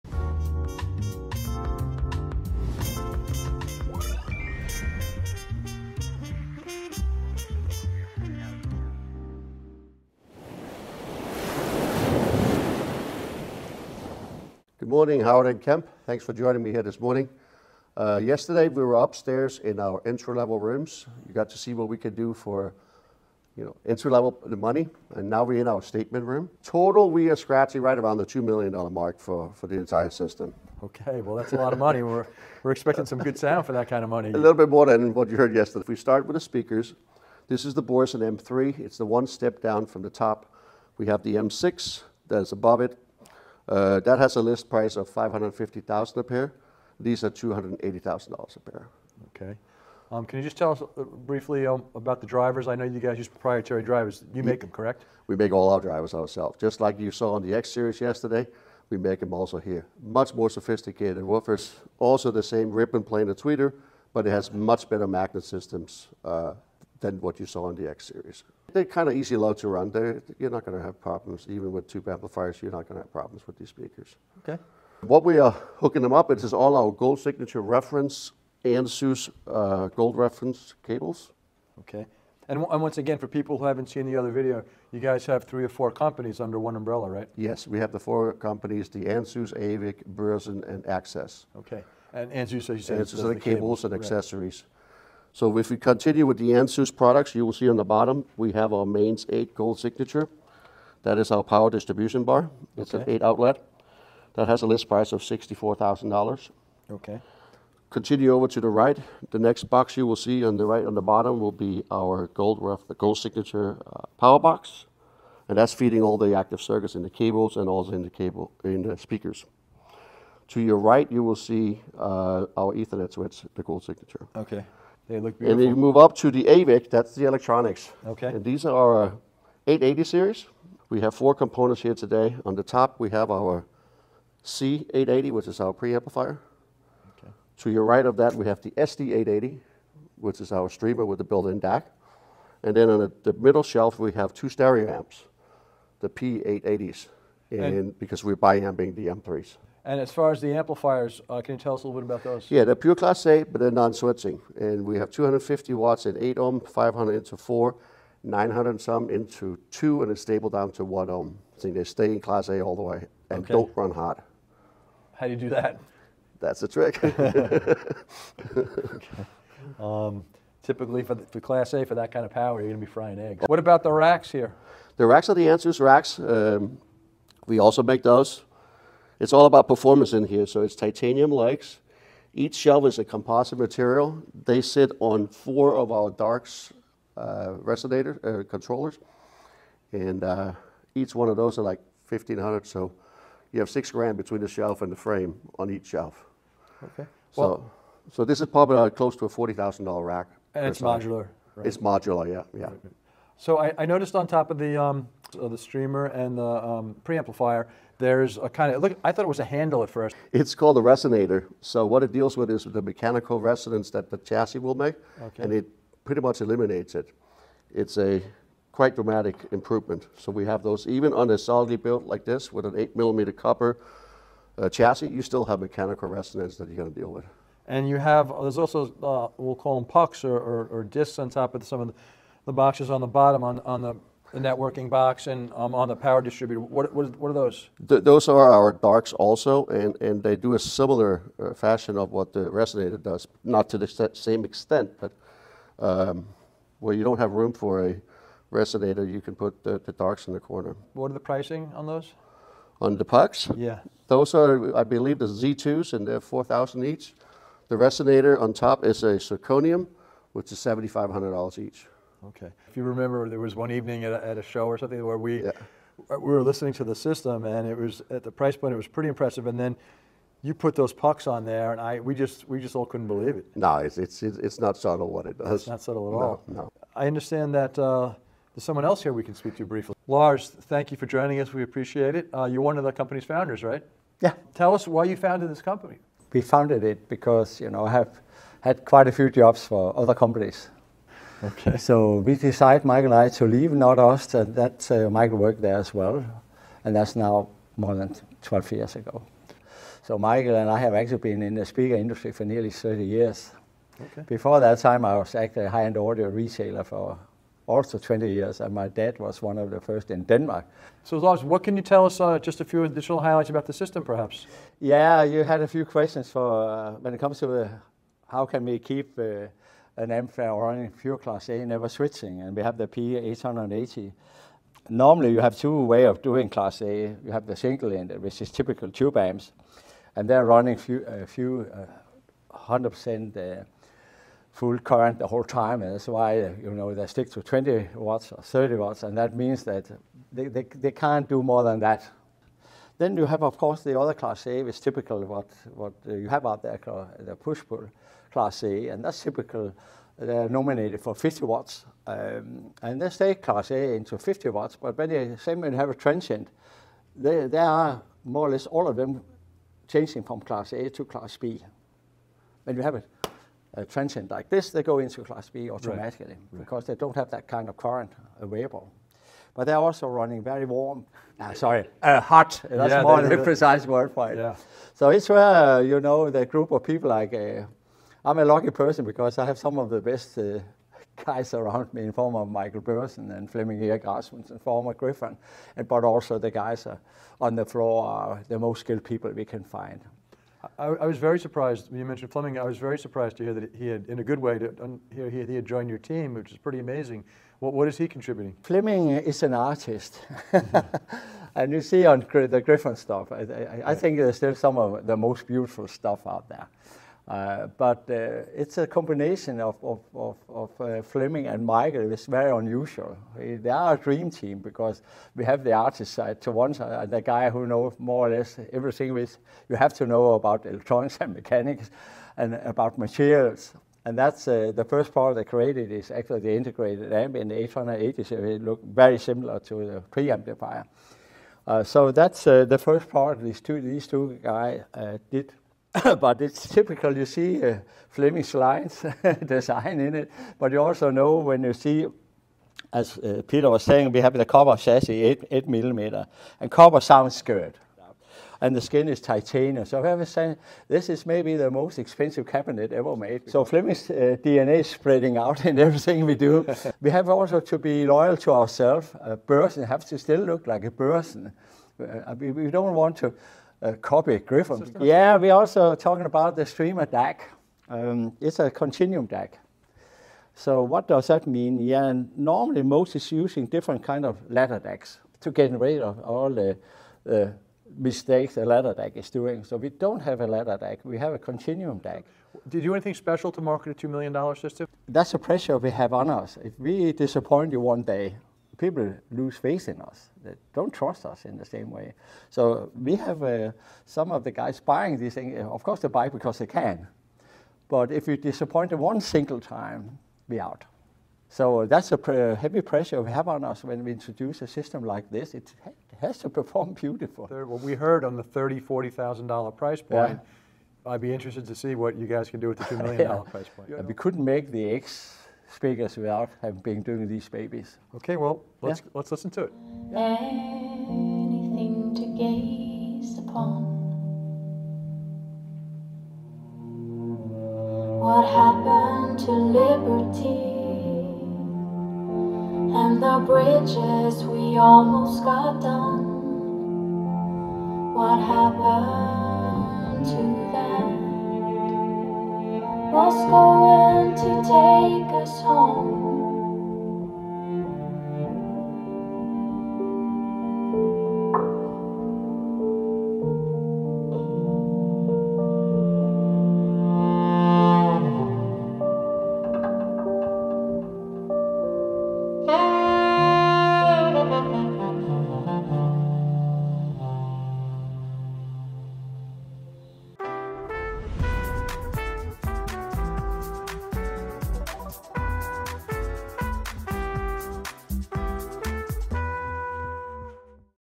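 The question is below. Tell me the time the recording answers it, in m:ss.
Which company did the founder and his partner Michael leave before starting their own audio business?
4:53.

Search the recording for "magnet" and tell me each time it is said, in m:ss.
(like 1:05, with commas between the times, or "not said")
1:05.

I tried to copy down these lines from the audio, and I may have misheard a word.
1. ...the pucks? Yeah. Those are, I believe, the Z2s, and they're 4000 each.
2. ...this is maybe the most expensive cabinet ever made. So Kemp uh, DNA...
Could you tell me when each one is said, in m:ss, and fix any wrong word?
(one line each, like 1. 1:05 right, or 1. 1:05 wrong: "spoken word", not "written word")
1. 4:12 right
2. 7:30 wrong: "Flemish", not "Kemp".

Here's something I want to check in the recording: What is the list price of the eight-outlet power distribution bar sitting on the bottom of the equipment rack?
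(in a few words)
$64,000.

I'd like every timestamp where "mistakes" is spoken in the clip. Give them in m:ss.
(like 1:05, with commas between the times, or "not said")
7:57.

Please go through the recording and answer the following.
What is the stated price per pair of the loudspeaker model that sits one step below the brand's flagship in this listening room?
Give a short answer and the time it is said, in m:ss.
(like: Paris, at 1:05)
$280,000, at 0:47.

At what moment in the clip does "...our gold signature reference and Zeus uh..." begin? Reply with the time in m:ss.
1:16.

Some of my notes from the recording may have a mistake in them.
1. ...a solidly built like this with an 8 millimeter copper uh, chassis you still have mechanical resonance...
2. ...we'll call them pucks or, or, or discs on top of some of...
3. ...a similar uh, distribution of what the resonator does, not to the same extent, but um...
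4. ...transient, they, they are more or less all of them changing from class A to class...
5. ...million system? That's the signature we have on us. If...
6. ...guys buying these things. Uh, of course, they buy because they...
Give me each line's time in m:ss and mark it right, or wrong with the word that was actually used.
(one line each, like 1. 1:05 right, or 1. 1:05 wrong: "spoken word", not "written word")
1. 3:41 right
2. 3:49 right
3. 4:00 wrong: "fashion", not "distribution"
4. 5:55 right
5. 8:04 wrong: "pressure", not "signature"
6. 8:14 right.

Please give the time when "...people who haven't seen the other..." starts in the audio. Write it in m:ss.
1:23.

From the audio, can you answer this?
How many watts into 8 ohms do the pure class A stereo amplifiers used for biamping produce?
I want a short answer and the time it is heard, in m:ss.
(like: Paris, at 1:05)
250 watts, at 2:35.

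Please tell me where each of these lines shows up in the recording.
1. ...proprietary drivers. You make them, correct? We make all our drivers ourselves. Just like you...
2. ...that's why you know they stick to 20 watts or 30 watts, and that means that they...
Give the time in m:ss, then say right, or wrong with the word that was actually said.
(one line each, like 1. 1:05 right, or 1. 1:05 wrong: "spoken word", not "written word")
1. 0:53 right
2. 5:35 right.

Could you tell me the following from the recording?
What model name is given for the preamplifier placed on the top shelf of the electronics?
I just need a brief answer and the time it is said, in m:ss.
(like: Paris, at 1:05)
C880, at 2:14.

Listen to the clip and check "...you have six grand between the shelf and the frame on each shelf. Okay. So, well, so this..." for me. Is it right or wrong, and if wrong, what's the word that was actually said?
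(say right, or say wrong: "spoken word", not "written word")
right.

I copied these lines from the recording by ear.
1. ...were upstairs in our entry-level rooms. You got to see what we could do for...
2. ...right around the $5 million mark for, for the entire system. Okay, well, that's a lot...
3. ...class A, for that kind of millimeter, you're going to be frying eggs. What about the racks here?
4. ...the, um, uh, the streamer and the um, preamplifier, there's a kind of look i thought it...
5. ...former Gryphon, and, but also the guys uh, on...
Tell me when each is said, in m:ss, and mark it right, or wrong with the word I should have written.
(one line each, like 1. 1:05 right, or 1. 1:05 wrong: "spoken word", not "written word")
1. 0:18 right
2. 0:27 wrong: "2", not "5"
3. 2:51 wrong: "power", not "millimeter"
4. 3:24 right
5. 6:24 right.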